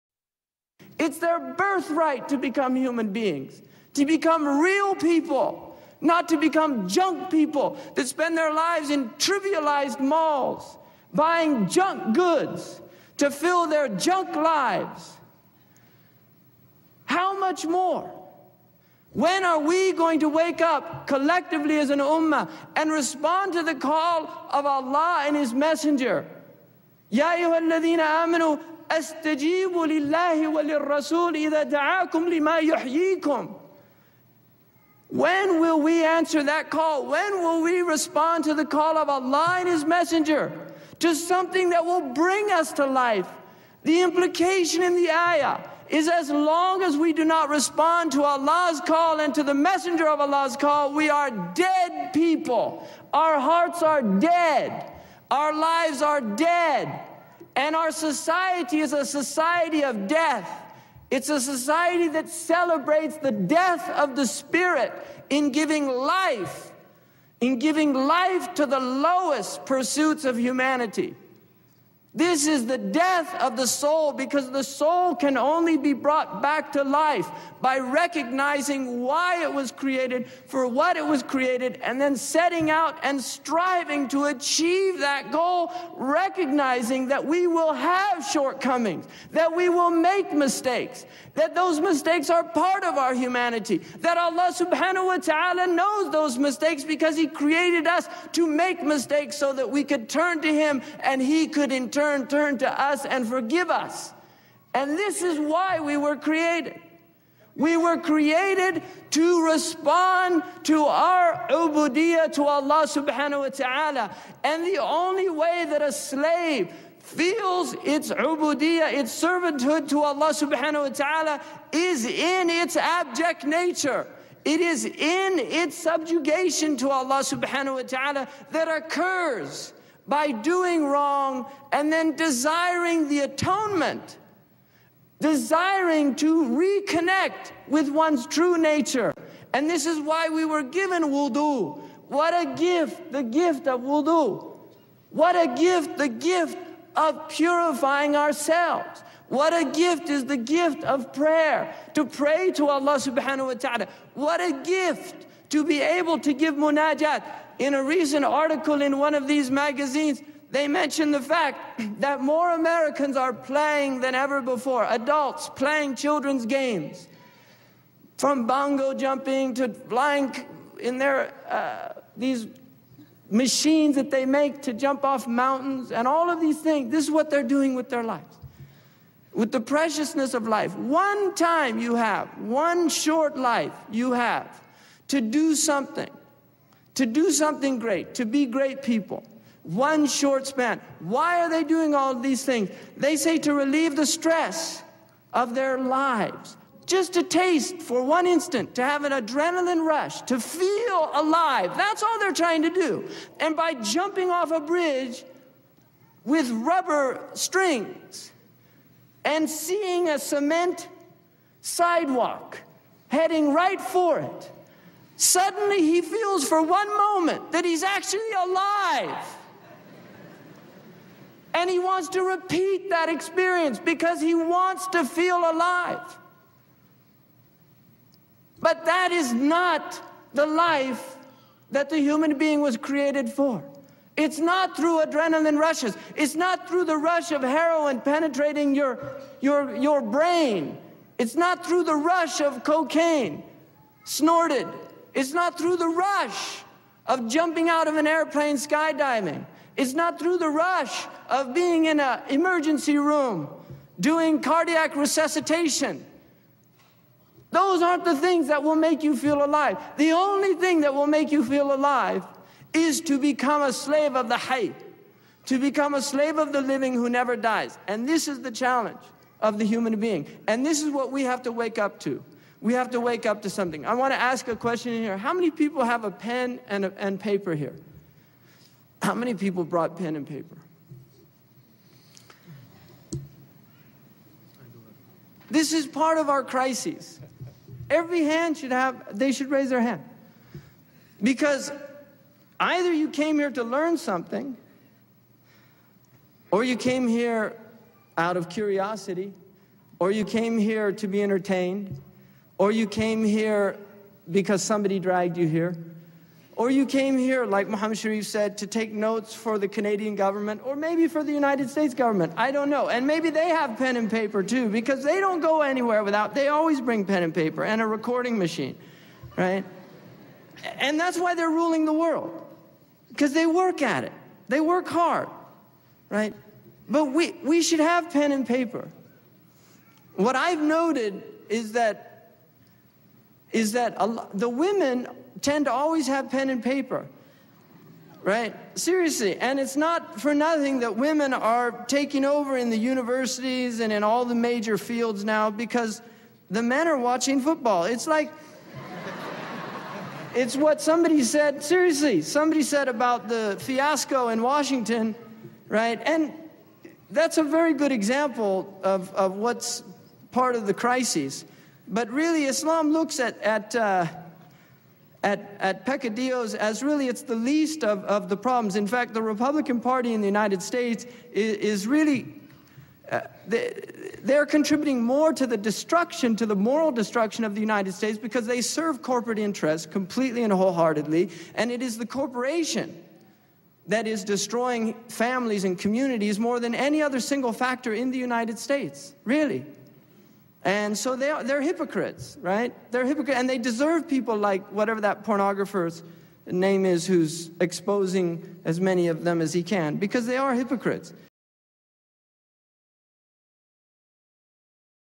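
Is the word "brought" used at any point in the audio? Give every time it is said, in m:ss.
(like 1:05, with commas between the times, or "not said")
1:15, 4:39.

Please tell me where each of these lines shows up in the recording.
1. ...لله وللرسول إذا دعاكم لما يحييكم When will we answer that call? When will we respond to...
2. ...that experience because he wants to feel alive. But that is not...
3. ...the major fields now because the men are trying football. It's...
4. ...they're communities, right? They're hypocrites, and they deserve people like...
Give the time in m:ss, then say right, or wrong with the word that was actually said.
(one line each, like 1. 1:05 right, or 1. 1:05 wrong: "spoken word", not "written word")
1. 0:29 right
2. 3:42 right
3. 5:44 wrong: "watching", not "trying"
4. 6:31 wrong: "hypocrites", not "communities".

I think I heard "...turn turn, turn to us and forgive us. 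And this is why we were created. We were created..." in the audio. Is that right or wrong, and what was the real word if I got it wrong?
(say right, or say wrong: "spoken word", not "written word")
right.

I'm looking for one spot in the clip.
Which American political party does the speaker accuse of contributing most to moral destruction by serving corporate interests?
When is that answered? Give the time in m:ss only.
6:09.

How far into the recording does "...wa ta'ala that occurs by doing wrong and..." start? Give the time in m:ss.
2:07.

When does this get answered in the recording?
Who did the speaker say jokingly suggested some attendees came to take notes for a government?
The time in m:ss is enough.
5:07.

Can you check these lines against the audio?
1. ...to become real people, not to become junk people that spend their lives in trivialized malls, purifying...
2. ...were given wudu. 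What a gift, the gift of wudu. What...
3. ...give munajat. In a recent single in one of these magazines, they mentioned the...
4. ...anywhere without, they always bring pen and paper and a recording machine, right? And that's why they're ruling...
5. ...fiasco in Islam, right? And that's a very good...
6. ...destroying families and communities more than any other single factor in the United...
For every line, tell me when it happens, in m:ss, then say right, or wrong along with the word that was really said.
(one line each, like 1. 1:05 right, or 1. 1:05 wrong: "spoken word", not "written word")
1. 0:03 wrong: "buying", not "purifying"
2. 2:20 right
3. 2:36 wrong: "article", not "single"
4. 5:15 right
5. 5:53 wrong: "Washington", not "Islam"
6. 6:24 right.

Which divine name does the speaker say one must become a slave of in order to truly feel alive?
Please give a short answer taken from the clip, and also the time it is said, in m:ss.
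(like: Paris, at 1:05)
the Hayy, at 4:24.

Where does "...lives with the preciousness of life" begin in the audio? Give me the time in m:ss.
2:58.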